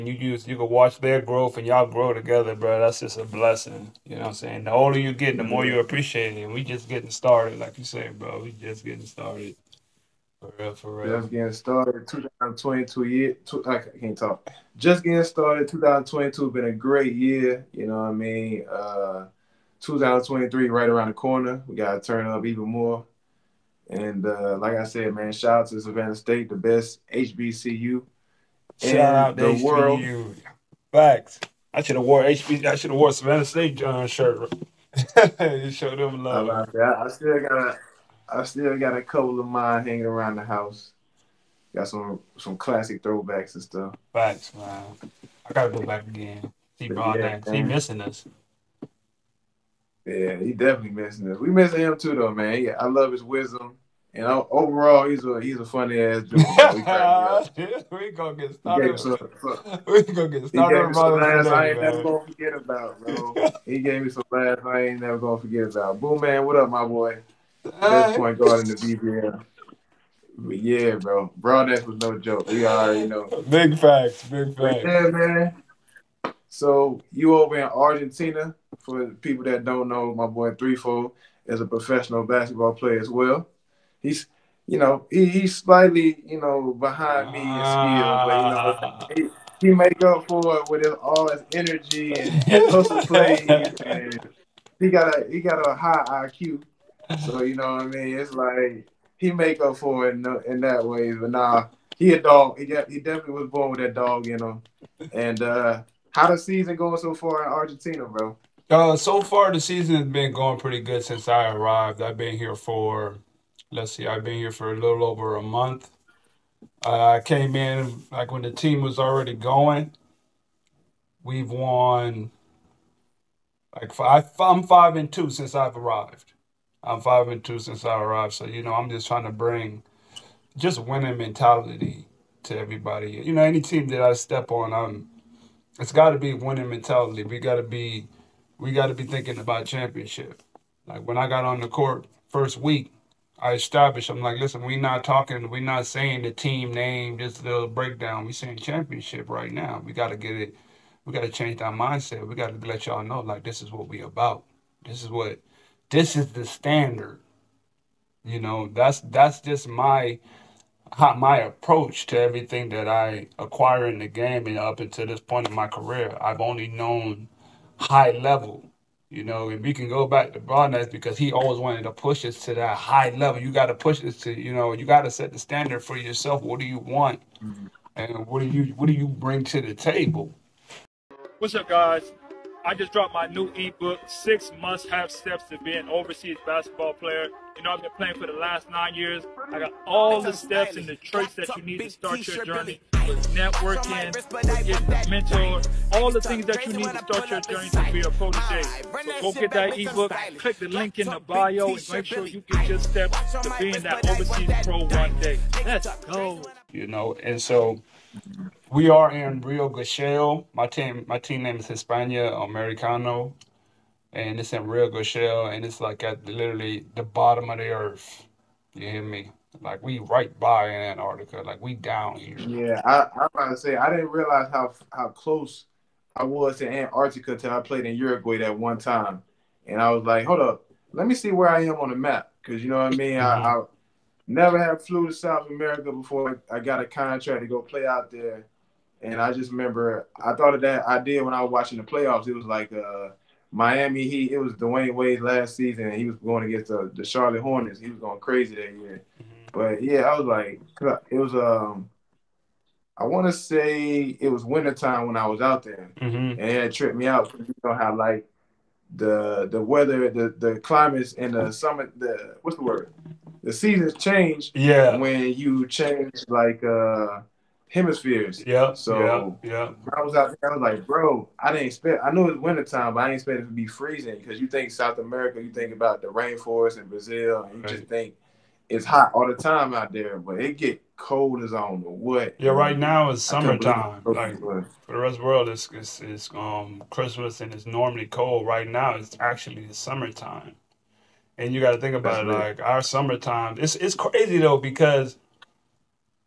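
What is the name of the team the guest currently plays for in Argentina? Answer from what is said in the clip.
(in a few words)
Hispano Americano.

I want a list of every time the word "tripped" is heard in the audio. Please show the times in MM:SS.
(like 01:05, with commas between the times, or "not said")
04:16.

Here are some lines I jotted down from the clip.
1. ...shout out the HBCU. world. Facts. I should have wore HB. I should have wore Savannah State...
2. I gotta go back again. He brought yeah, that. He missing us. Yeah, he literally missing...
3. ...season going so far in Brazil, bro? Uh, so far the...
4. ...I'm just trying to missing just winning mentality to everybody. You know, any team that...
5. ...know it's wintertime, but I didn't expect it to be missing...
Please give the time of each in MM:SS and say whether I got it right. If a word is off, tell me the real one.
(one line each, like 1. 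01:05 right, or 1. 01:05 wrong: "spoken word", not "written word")
1. 00:28 right
2. 00:45 wrong: "definitely", not "literally"
3. 01:46 wrong: "Argentina", not "Brazil"
4. 02:08 wrong: "bring", not "missing"
5. 04:32 wrong: "freezing", not "missing".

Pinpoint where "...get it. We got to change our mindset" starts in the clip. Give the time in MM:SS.
02:30.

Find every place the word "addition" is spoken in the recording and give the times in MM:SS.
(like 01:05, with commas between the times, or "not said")
not said.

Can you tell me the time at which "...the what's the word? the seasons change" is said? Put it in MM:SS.
04:21.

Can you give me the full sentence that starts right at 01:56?
Uh, I came in like when the team was already going.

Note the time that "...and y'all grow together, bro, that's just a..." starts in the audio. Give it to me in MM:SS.
00:01.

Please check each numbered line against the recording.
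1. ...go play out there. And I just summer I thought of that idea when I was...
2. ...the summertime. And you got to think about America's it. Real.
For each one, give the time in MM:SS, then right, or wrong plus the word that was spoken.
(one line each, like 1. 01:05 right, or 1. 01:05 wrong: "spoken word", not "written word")
1. 03:57 wrong: "remember", not "summer"
2. 04:49 wrong: "That", not "America".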